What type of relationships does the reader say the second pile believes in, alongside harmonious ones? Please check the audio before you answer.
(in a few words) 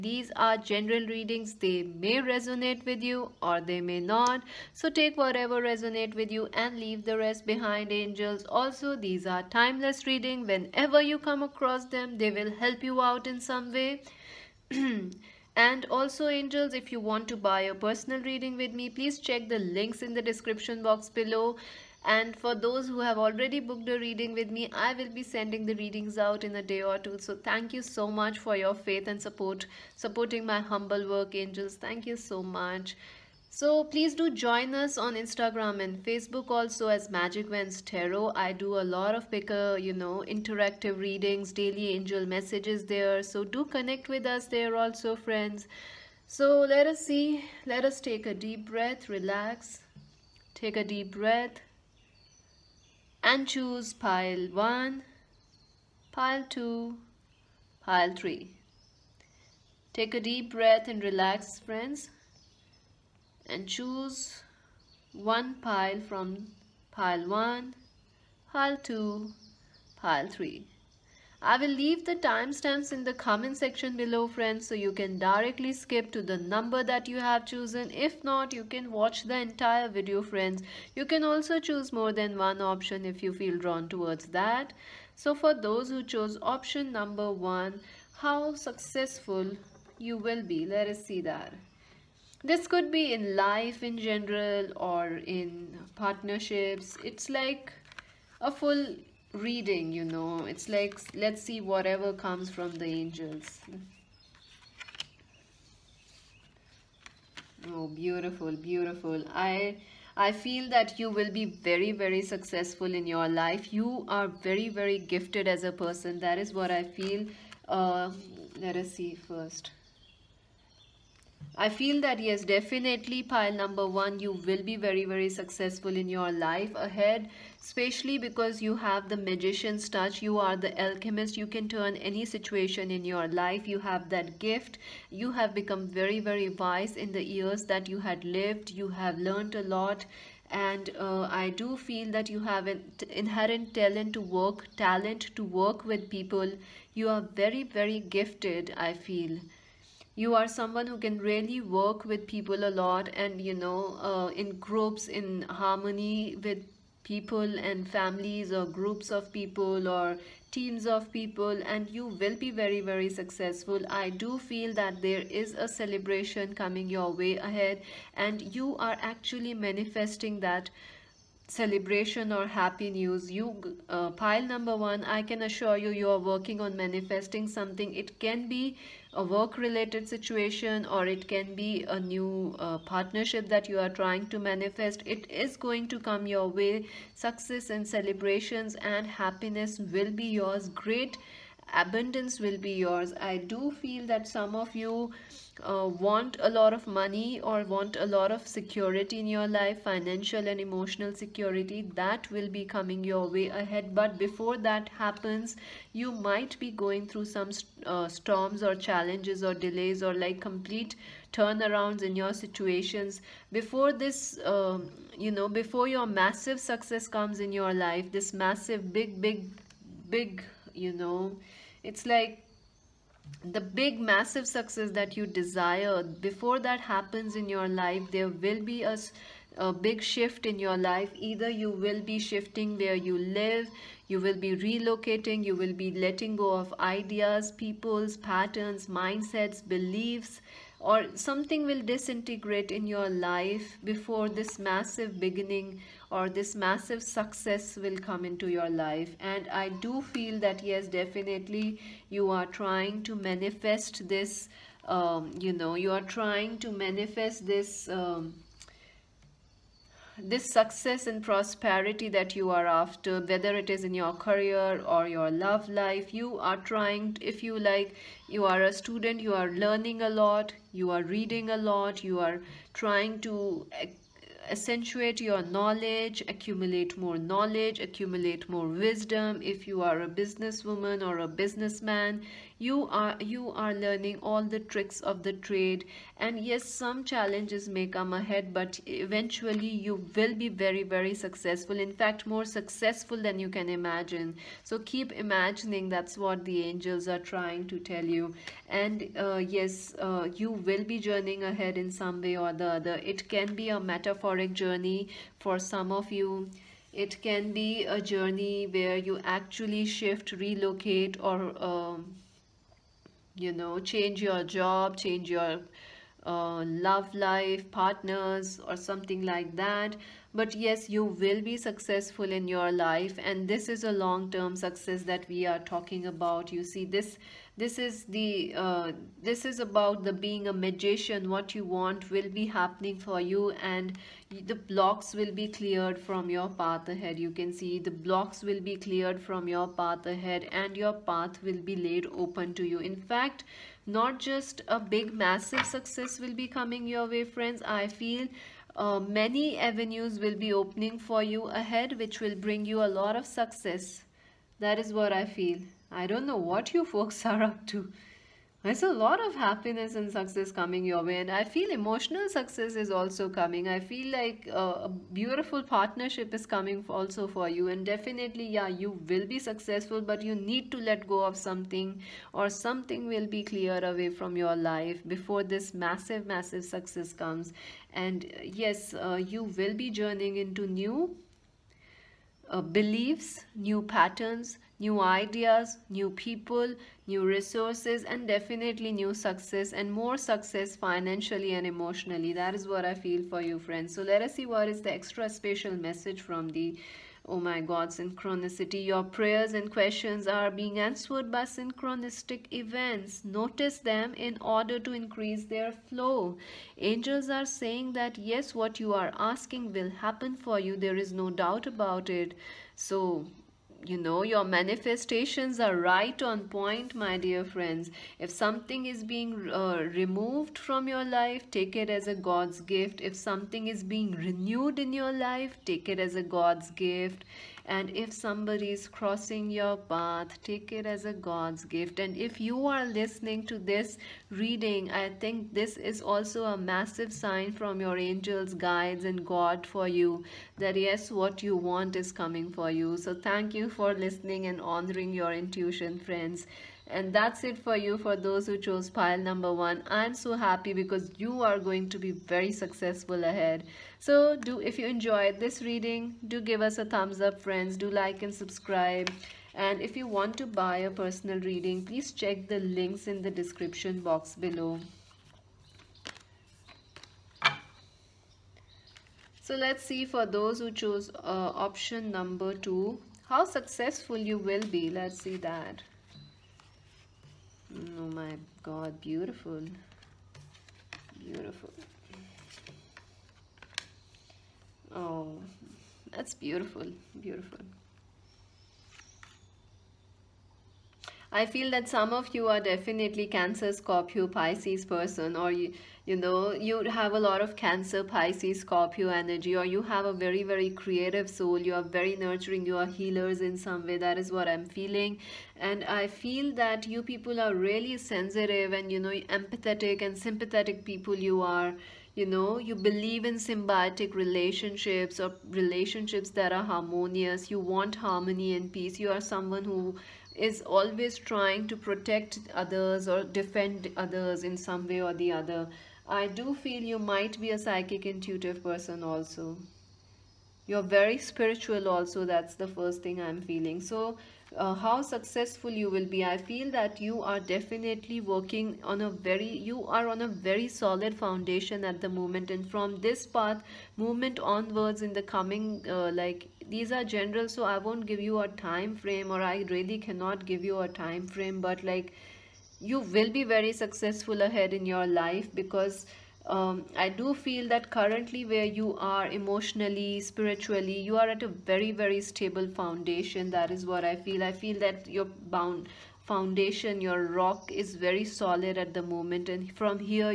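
Symbiotic relationships.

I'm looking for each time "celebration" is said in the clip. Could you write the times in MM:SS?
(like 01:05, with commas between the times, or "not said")
02:45, 02:51, 03:07.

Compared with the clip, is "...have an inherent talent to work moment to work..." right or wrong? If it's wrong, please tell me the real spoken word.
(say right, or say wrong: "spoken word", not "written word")
wrong: "talent", not "moment".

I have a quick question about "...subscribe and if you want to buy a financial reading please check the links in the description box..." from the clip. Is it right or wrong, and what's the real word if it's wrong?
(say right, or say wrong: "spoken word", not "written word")
wrong: "personal", not "financial".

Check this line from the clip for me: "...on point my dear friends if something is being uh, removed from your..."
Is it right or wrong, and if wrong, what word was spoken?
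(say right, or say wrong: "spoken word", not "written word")
right.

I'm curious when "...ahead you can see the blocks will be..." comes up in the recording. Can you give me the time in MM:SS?
05:36.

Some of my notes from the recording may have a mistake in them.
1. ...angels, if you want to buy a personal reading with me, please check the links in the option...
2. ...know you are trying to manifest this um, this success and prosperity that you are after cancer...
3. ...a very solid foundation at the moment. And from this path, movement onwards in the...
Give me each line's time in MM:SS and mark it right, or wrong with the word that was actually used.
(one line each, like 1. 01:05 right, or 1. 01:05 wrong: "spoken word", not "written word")
1. 00:16 wrong: "description", not "option"
2. 04:15 wrong: "whether", not "cancer"
3. 09:00 right.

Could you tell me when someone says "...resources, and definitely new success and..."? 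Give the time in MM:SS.
06:27.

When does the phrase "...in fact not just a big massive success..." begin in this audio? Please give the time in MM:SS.
05:42.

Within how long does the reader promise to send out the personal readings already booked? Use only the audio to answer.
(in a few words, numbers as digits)
a day or two.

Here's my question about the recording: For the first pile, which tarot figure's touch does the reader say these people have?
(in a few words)
The magician.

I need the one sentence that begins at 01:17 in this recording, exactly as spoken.
If not, you can watch the entire video friends.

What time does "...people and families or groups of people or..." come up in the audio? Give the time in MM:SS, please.
02:37.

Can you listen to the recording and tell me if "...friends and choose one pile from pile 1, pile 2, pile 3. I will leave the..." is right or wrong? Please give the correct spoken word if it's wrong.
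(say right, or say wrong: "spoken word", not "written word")
right.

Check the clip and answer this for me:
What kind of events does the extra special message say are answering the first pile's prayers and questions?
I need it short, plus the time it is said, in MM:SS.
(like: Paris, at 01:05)
Synchronistic events, at 06:41.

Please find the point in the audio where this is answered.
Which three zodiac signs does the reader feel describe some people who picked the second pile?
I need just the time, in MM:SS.
08:13.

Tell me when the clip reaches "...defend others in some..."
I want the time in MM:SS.
08:43.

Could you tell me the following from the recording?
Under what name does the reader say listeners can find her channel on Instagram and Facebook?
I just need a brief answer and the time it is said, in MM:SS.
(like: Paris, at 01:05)
Magic Wands Tarot, at 00:37.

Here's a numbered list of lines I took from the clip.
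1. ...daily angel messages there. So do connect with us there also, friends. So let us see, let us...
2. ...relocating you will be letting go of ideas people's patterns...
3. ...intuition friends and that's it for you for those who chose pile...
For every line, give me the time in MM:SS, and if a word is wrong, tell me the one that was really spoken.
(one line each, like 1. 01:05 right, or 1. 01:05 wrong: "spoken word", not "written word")
1. 00:41 right
2. 03:54 right
3. 07:25 right.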